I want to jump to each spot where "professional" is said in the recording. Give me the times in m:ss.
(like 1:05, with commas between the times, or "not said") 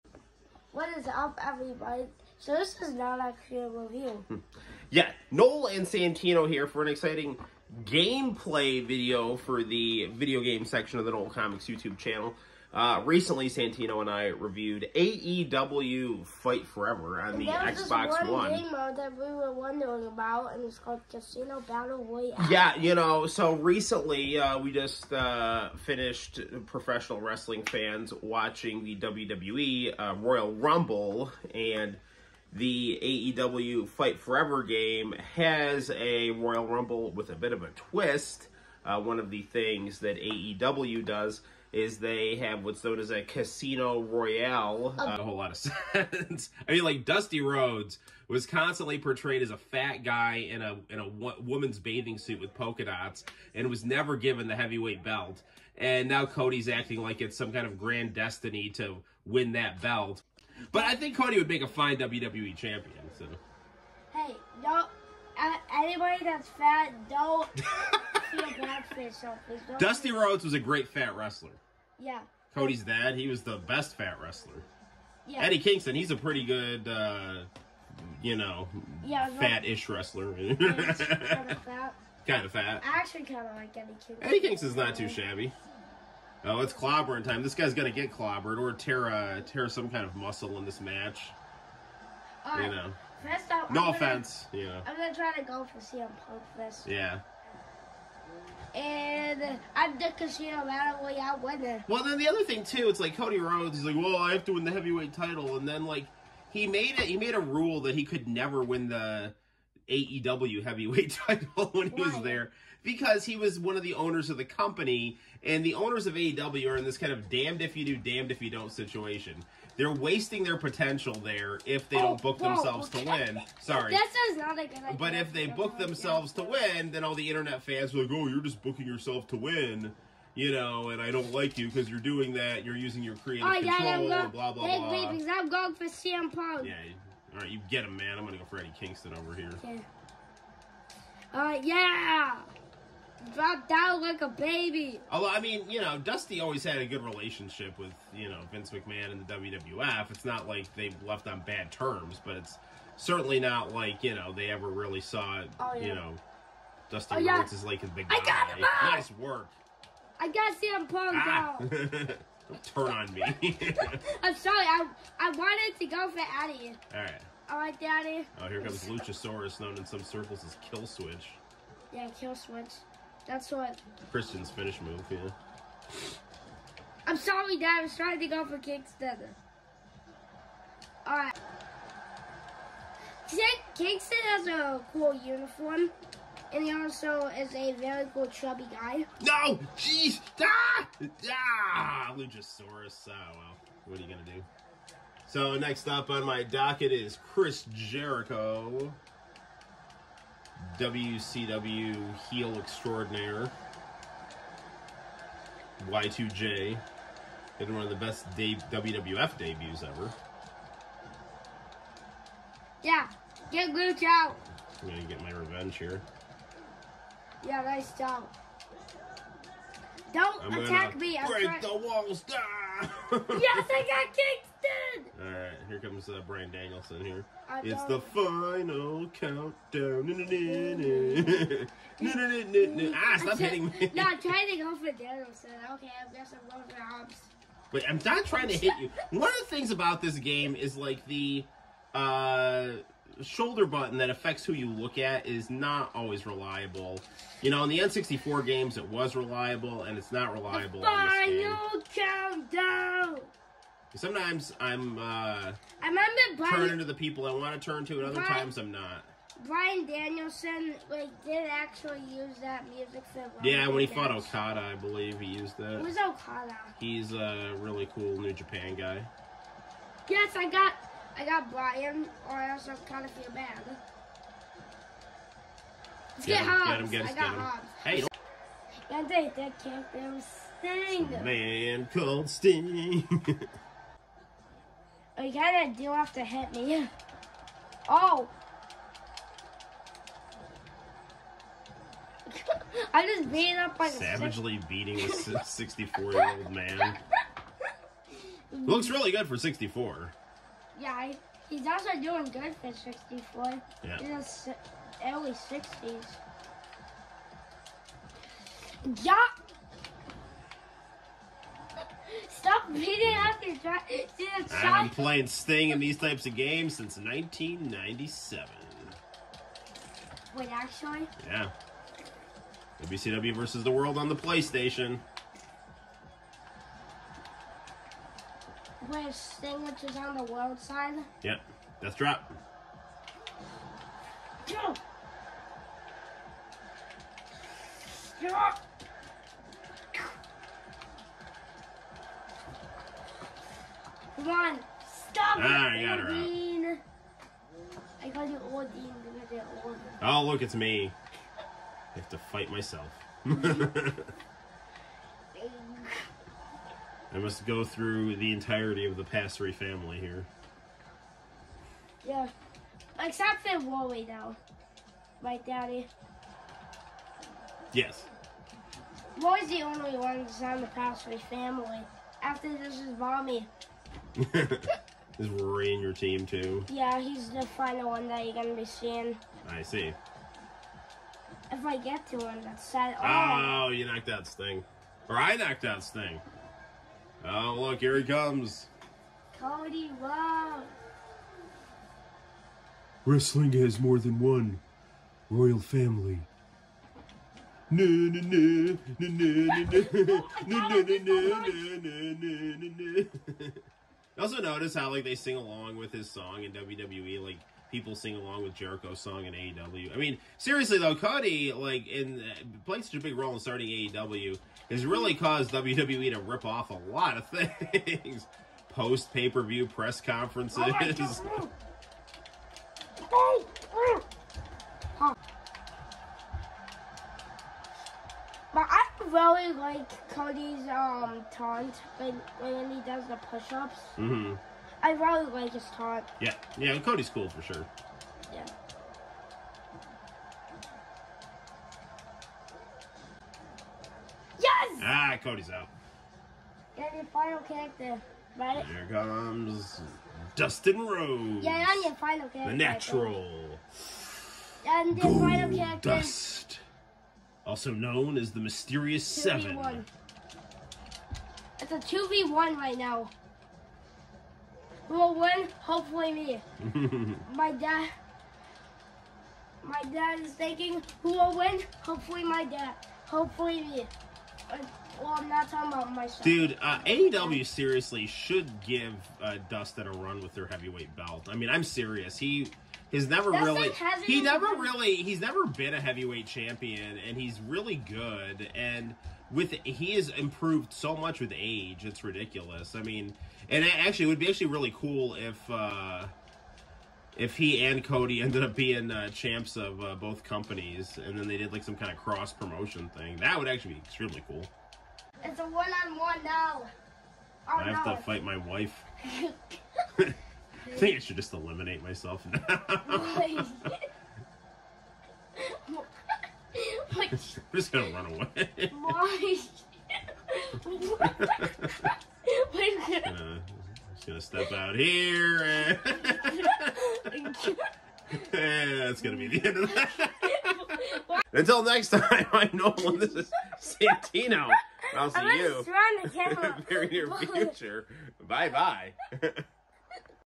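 0:26.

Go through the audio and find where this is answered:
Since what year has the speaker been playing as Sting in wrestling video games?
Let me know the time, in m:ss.
5:16.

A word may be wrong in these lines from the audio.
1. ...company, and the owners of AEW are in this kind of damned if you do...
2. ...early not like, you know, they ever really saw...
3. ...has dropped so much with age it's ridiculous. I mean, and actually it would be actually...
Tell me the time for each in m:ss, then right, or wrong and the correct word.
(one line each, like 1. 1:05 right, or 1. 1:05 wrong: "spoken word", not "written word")
1. 1:54 right
2. 2:32 wrong: "certainly", not "early"
3. 8:09 wrong: "improved", not "dropped".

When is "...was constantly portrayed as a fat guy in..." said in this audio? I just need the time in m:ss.
0:48.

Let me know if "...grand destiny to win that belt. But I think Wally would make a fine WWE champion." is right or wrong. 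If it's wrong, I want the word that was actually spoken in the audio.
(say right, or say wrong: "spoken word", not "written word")
wrong: "Cody", not "Wally".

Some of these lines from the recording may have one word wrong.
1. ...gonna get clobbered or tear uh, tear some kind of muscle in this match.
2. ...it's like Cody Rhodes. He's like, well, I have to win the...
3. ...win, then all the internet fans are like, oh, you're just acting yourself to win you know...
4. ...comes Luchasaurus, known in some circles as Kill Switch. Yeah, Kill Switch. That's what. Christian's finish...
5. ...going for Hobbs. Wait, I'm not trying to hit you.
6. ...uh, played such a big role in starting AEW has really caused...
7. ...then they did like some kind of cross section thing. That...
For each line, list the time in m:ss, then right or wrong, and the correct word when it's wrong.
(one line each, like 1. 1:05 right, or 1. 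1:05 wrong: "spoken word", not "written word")
1. 1:27 right
2. 1:42 right
3. 2:06 wrong: "booking", not "acting"
4. 2:48 right
5. 3:56 right
6. 6:52 right
7. 8:21 wrong: "promotion", not "section".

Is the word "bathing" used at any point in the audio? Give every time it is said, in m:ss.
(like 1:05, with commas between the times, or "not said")
0:51.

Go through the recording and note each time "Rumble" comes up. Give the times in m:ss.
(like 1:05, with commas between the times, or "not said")
0:30, 0:36.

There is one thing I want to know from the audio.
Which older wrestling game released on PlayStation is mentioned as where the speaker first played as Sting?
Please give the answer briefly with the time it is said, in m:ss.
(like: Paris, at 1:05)
WCW versus the World, at 5:22.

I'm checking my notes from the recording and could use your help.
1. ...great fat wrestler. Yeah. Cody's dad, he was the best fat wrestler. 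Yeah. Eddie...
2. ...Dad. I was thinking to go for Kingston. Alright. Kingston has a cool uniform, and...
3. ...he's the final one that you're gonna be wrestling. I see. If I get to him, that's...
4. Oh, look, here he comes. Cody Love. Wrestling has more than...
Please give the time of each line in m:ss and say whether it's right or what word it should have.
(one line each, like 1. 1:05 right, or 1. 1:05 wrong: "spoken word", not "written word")
1. 1:10 right
2. 2:57 wrong: "trying", not "thinking"
3. 6:16 wrong: "seeing", not "wrestling"
4. 6:27 right.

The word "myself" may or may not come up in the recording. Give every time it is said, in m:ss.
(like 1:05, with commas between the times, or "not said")
5:52, 7:55, 8:31.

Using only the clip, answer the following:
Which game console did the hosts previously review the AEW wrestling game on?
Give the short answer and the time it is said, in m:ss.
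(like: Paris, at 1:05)
Xbox One, at 0:17.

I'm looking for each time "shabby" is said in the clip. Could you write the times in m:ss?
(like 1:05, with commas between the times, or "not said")
1:25.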